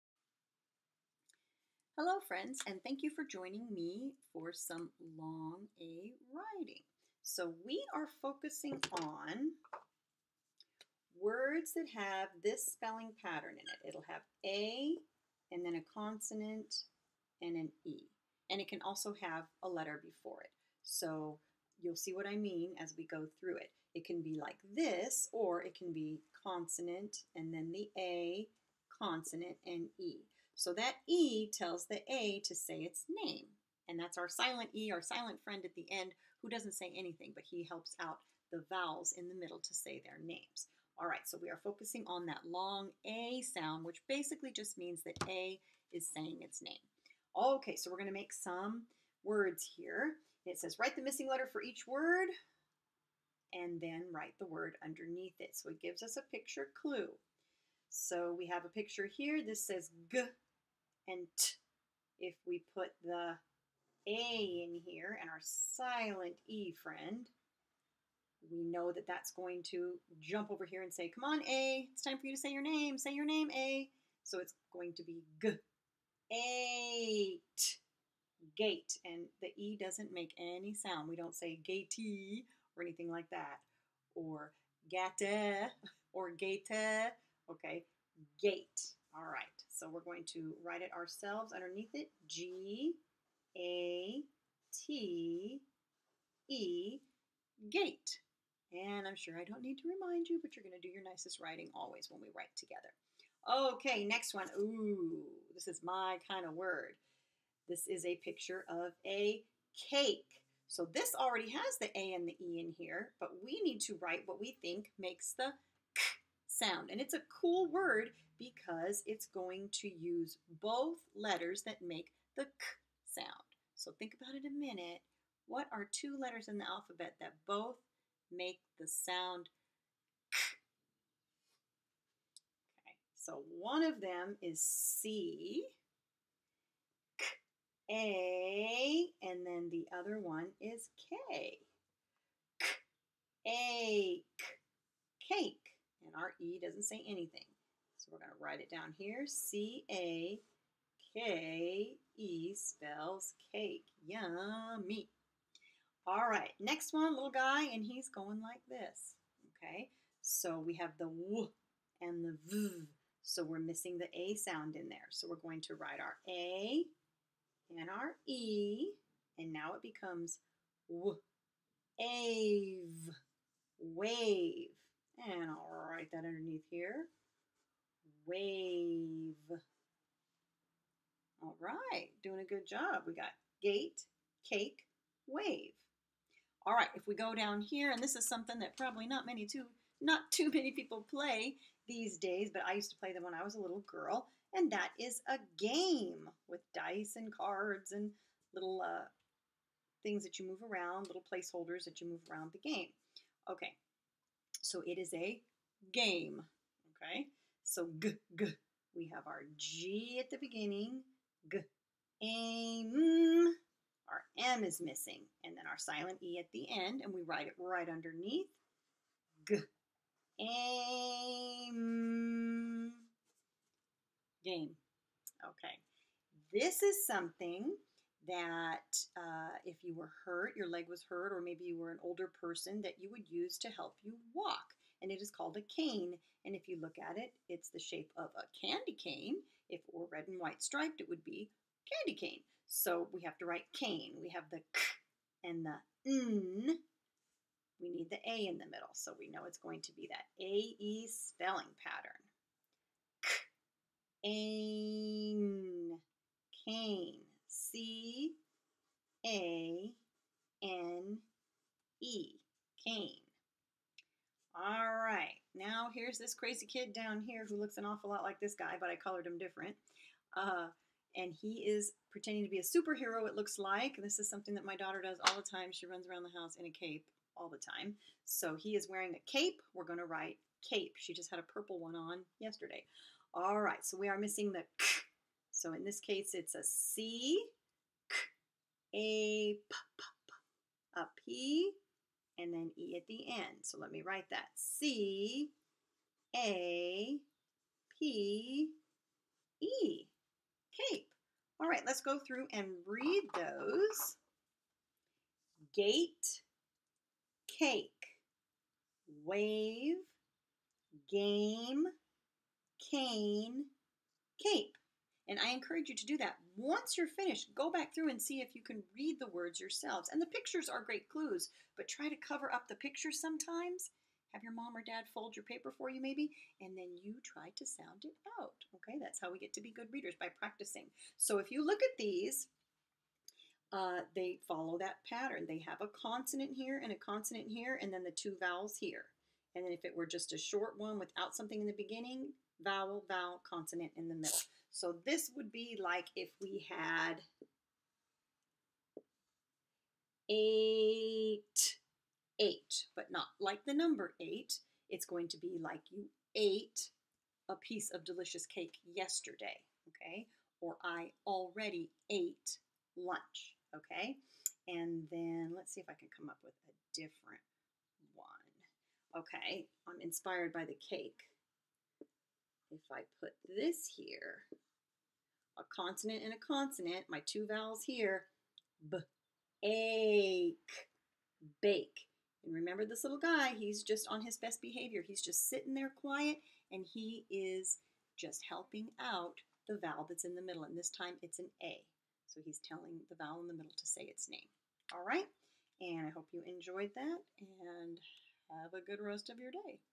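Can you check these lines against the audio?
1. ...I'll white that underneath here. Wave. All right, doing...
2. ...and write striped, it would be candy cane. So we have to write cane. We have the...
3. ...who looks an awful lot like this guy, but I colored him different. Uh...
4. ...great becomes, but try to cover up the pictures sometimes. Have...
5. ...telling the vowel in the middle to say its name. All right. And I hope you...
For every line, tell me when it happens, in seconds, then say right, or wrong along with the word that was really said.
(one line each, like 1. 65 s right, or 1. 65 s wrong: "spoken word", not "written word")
1. 175 s wrong: "write", not "white"
2. 240 s wrong: "white", not "write"
3. 267 s right
4. 320 s wrong: "clues", not "becomes"
5. 392 s right.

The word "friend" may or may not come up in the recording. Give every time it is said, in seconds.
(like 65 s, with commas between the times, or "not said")
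2 s, 35 s, 66 s.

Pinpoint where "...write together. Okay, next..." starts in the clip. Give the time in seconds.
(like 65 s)
102 s.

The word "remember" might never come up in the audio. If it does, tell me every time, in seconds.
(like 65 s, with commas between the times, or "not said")
382 s.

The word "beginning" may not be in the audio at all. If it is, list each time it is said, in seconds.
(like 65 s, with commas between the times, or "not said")
210 s, 341 s.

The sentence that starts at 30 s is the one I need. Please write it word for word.
So that E tells the A to say its name.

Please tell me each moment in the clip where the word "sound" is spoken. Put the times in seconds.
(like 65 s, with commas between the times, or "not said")
43 s, 80 s, 116 s, 123 s, 128 s, 164 s, 327 s.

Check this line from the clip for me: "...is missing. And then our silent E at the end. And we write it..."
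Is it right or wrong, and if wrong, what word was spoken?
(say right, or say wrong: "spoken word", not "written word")
right.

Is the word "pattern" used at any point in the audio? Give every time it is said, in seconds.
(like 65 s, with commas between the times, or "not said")
13 s, 251 s, 335 s.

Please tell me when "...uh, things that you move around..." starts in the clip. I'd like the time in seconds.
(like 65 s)
198 s.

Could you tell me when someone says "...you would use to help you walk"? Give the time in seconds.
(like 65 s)
232 s.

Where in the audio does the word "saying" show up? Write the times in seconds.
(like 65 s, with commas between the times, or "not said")
46 s.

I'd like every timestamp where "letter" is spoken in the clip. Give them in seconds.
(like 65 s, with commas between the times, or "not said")
19 s, 51 s, 121 s, 126 s.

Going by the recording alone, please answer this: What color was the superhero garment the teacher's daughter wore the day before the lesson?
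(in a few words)
purple.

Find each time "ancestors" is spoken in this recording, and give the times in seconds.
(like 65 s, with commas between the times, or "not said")
not said.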